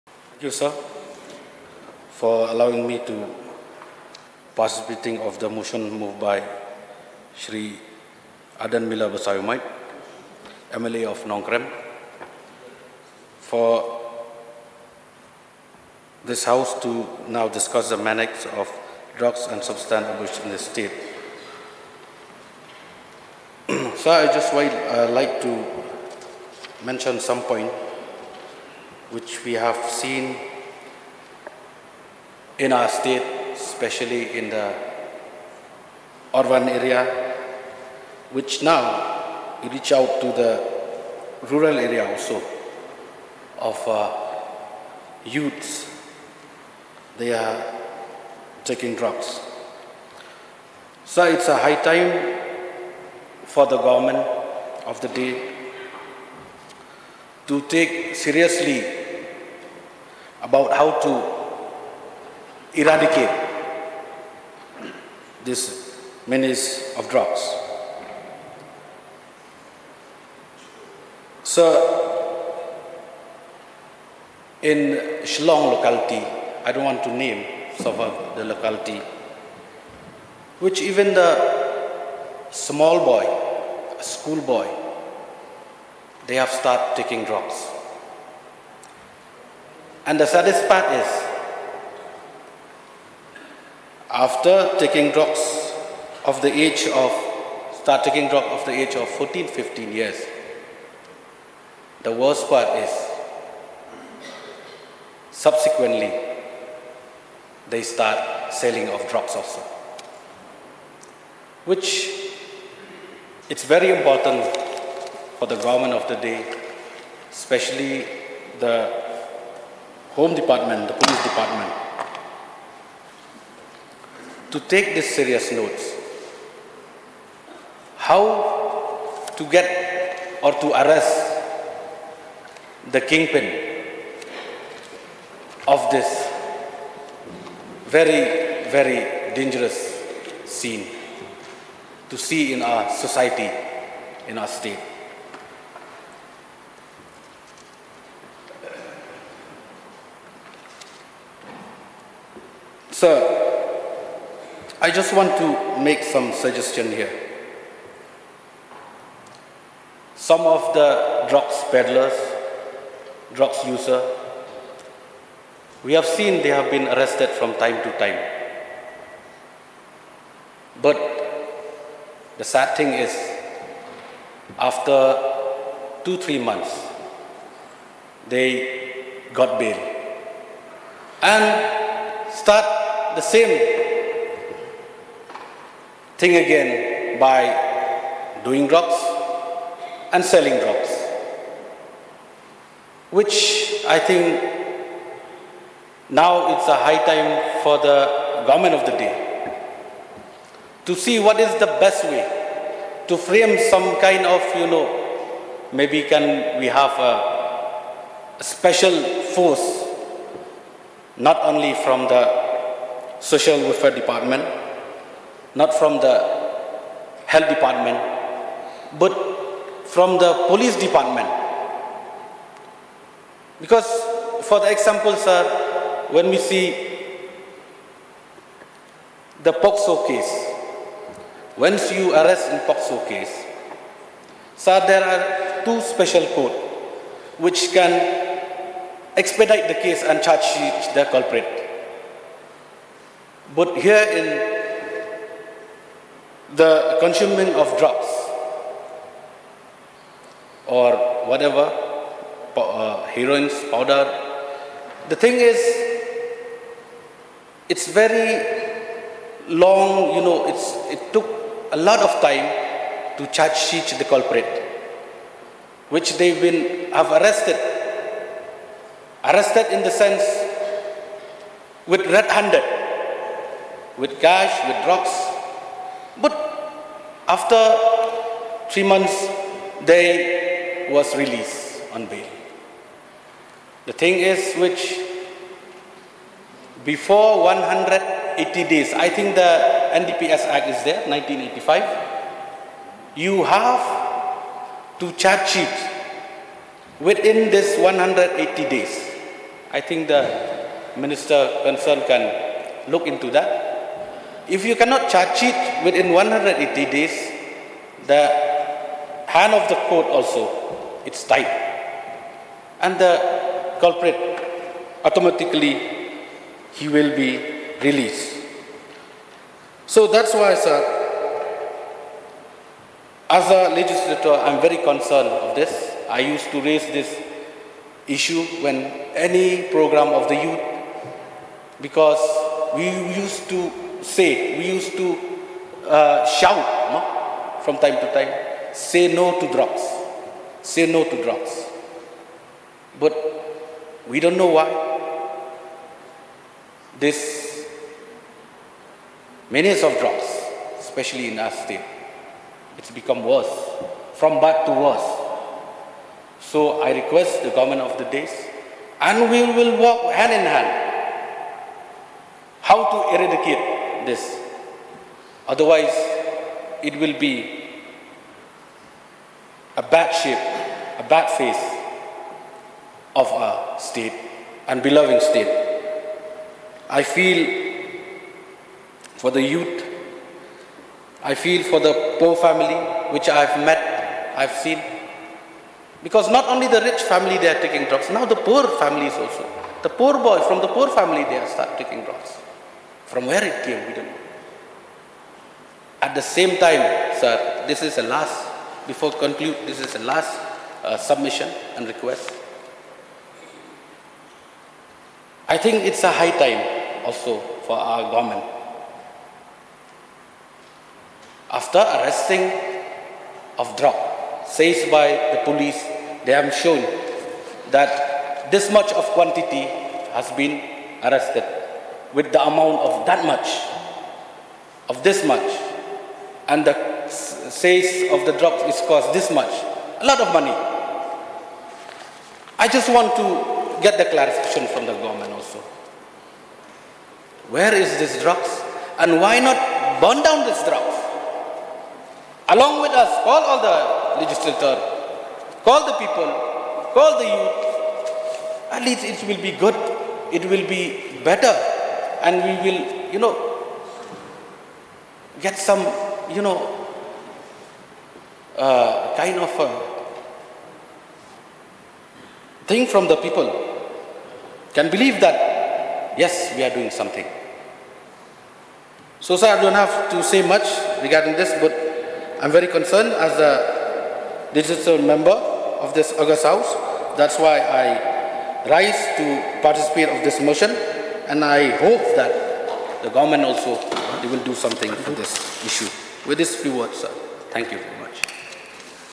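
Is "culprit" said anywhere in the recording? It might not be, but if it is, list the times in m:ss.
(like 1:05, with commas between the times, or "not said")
4:01, 4:24, 5:13.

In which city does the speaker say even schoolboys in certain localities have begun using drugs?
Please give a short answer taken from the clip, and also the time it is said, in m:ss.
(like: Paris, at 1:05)
Shillong, at 1:15.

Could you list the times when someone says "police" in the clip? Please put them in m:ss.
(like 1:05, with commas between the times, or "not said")
2:00, 3:40, 6:55.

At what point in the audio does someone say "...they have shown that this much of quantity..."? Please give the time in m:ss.
6:56.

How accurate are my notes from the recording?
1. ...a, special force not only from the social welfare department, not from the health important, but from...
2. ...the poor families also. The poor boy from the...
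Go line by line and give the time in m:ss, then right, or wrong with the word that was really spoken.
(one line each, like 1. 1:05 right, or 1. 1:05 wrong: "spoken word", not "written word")
1. 3:26 wrong: "department", not "important"
2. 6:28 right.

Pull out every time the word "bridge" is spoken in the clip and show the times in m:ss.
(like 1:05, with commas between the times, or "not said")
not said.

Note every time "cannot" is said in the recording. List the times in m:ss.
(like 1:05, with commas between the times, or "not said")
5:04.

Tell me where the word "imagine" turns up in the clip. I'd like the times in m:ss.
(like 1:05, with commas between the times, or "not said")
not said.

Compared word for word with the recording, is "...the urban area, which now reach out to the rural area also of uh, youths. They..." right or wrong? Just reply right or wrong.
right.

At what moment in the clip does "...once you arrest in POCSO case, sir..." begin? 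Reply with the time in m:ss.
3:51.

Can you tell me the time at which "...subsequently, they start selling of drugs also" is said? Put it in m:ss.
1:45.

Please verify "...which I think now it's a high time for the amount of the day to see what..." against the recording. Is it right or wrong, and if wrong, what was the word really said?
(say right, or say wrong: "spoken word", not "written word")
wrong: "government", not "amount".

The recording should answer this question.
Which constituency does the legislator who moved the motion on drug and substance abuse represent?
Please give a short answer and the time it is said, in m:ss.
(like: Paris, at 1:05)
Nongkrem, at 0:11.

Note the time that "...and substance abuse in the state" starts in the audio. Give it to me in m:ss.
0:19.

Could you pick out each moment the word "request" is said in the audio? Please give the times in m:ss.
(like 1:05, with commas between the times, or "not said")
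5:56, 6:41.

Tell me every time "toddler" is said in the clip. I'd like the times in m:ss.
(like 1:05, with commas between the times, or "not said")
not said.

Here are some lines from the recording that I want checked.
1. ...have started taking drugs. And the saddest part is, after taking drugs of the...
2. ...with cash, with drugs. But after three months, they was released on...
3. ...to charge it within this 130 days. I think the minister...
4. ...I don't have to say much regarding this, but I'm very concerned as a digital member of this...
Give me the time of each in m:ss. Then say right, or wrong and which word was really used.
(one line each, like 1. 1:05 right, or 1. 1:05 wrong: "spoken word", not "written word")
1. 1:26 right
2. 4:34 right
3. 4:54 wrong: "180", not "130"
4. 7:49 right.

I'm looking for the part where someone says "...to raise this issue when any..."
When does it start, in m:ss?
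5:26.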